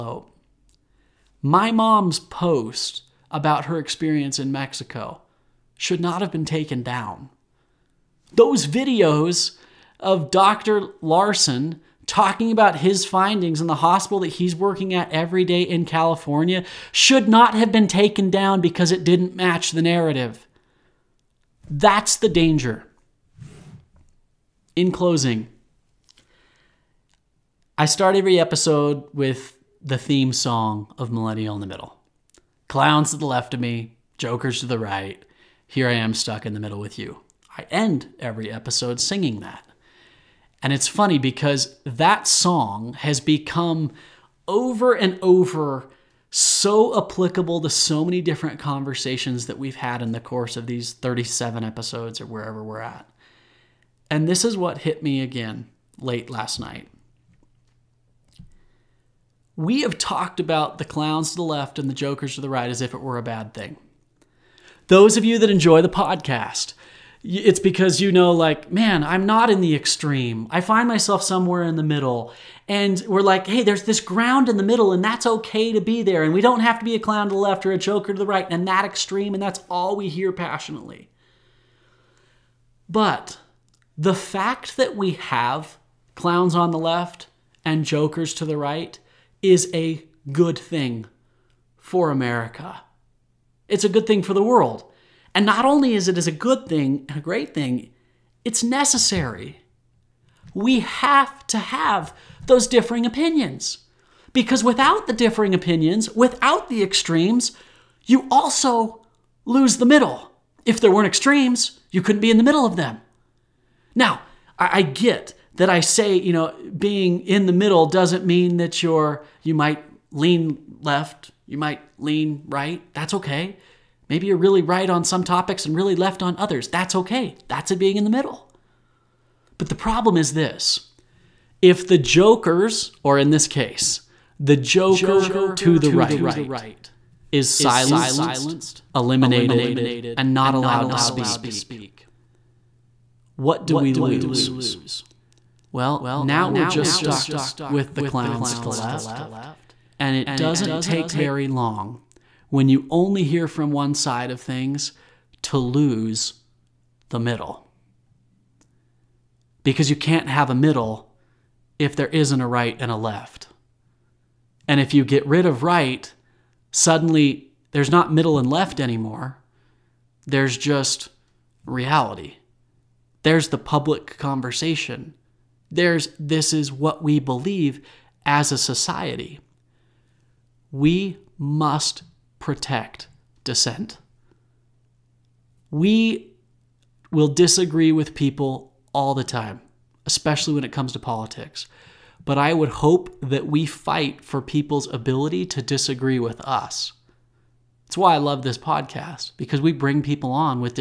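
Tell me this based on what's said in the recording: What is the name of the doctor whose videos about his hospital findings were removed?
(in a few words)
Dr. Larson.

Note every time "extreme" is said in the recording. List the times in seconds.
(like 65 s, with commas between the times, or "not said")
69 s, 78 s, 106 s, 111 s.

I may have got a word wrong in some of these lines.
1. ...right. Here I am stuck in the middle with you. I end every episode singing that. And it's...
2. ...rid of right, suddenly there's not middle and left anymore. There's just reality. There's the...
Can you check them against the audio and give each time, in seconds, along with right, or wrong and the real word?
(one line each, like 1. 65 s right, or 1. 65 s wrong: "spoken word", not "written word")
1. 34 s right
2. 165 s right.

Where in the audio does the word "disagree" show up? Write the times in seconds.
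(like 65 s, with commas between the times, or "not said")
187 s, 195 s.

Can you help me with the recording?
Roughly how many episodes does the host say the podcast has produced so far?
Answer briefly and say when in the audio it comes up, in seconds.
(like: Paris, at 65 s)
37, at 50 s.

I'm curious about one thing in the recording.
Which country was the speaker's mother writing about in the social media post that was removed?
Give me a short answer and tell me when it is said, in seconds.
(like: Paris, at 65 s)
Mexico, at 4 s.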